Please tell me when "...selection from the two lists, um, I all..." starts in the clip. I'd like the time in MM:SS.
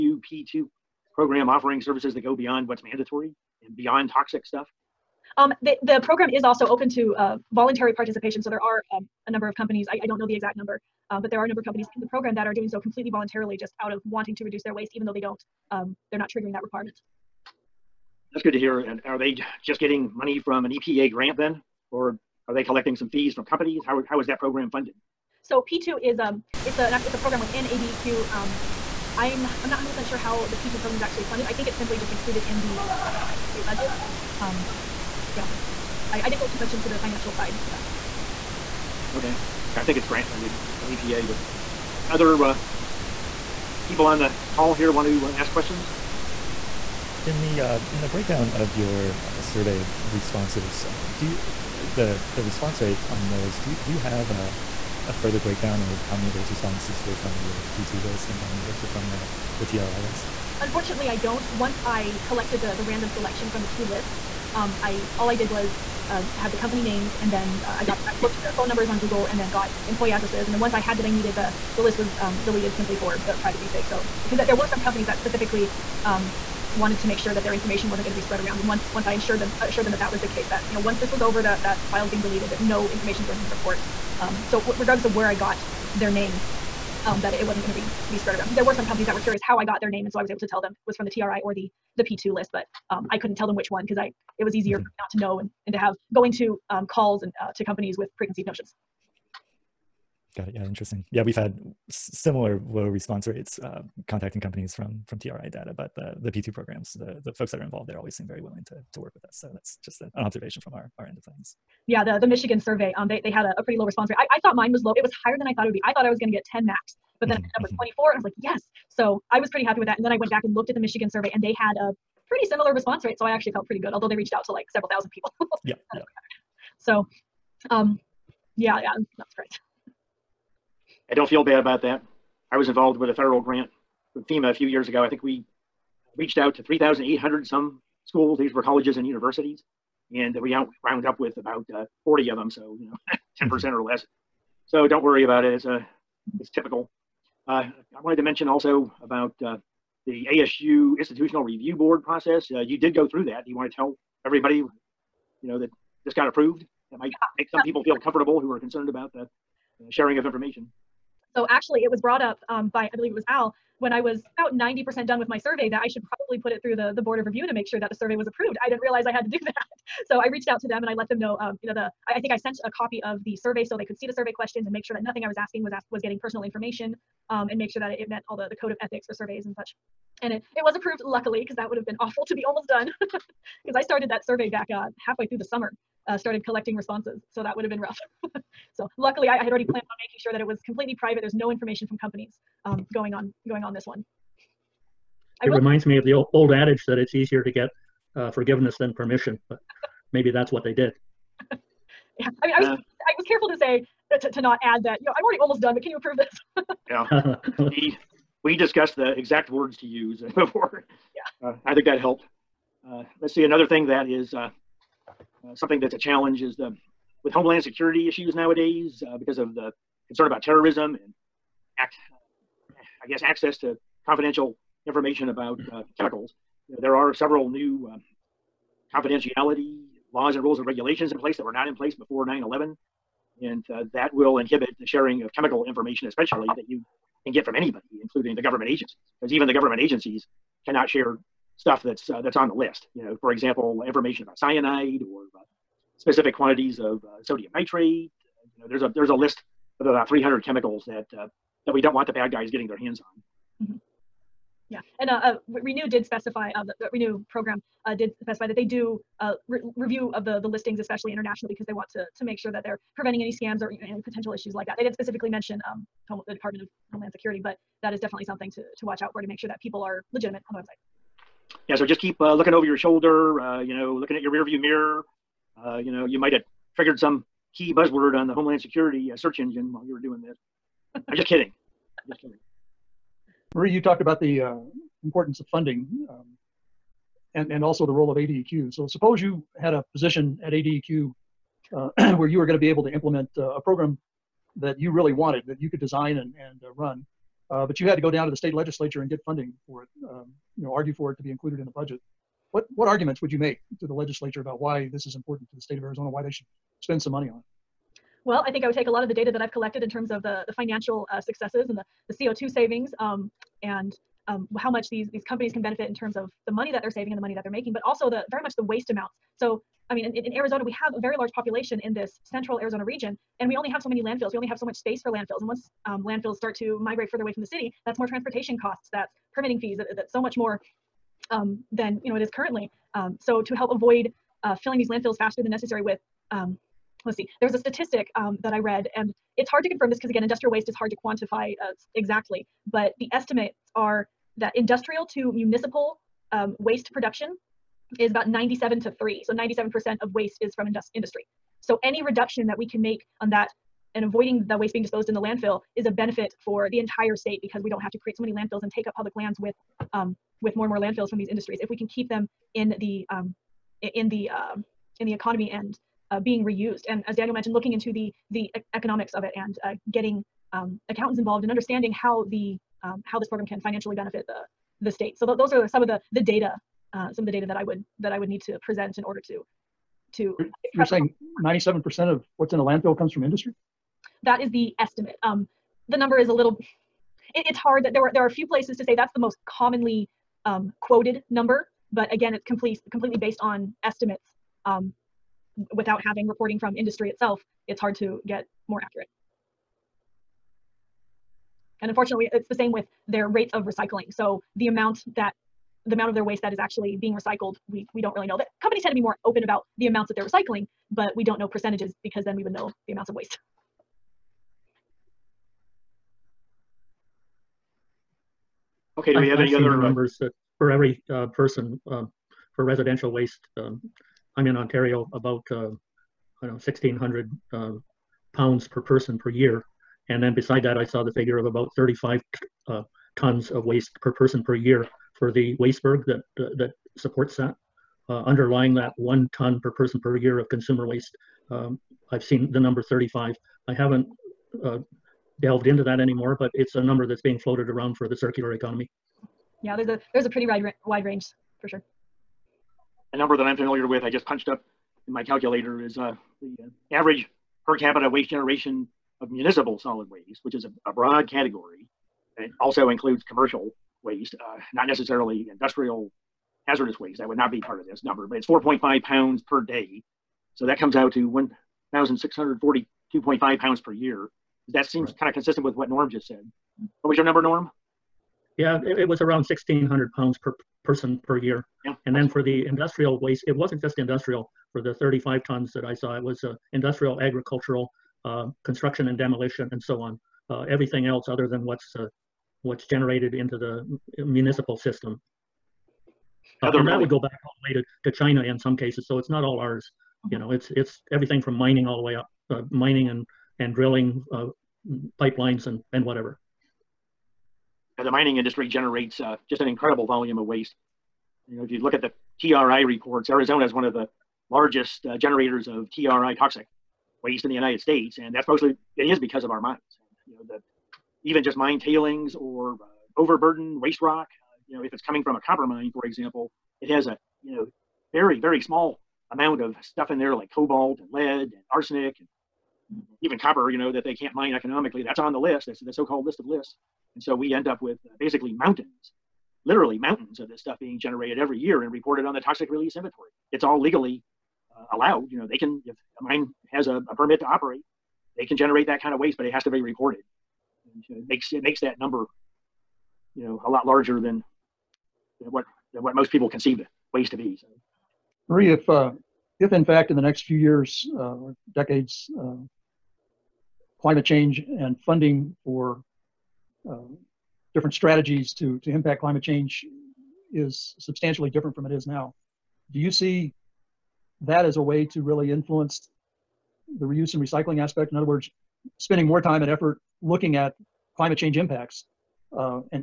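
01:03.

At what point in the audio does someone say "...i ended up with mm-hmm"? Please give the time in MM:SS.
01:57.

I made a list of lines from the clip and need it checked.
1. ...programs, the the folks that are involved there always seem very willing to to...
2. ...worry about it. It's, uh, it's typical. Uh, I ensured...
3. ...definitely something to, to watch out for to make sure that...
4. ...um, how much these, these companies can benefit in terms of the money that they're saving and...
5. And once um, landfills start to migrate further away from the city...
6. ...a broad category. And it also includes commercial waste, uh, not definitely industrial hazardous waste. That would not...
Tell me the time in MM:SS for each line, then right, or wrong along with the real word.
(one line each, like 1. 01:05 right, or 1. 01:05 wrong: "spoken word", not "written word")
1. 01:46 right
2. 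02:25 wrong: "wanted", not "ensured"
3. 04:27 right
4. 05:14 right
5. 05:25 right
6. 07:40 wrong: "necessarily", not "definitely".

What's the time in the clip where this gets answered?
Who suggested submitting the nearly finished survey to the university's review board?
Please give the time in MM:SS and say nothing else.
02:43.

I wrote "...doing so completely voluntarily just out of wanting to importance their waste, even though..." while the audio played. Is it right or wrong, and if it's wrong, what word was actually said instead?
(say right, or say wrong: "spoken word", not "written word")
wrong: "reduce", not "importance".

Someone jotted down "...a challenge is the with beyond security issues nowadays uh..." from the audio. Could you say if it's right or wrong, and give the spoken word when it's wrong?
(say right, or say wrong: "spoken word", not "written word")
wrong: "homeland", not "beyond".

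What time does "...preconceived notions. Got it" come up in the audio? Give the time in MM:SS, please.
01:38.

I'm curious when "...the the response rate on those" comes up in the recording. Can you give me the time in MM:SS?
00:51.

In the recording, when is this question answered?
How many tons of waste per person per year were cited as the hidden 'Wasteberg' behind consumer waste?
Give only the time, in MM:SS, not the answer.
07:11.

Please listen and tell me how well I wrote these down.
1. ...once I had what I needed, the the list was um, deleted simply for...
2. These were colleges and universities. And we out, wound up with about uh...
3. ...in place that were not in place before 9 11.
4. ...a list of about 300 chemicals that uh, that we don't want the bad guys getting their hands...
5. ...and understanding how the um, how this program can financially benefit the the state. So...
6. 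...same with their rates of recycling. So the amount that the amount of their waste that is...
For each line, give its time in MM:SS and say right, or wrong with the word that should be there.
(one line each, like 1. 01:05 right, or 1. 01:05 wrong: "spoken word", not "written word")
1. 01:10 right
2. 02:18 right
3. 03:51 right
4. 04:09 right
5. 06:11 right
6. 06:42 right.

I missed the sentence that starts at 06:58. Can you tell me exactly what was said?
Okay, do we have I, any i other uh, numbers uh, for every uh, person um, for residential waste?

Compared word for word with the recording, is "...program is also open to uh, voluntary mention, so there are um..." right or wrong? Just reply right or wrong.
wrong.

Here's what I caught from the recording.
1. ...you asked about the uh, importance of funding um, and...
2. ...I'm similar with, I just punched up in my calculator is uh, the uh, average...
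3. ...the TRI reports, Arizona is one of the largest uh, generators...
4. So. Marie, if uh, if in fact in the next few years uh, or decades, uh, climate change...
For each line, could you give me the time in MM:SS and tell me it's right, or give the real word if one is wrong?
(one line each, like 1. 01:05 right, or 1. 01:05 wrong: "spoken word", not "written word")
1. 04:43 wrong: "talked", not "asked"
2. 07:33 wrong: "familiar", not "similar"
3. 08:32 right
4. 09:17 right.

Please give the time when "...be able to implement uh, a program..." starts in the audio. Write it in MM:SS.
04:52.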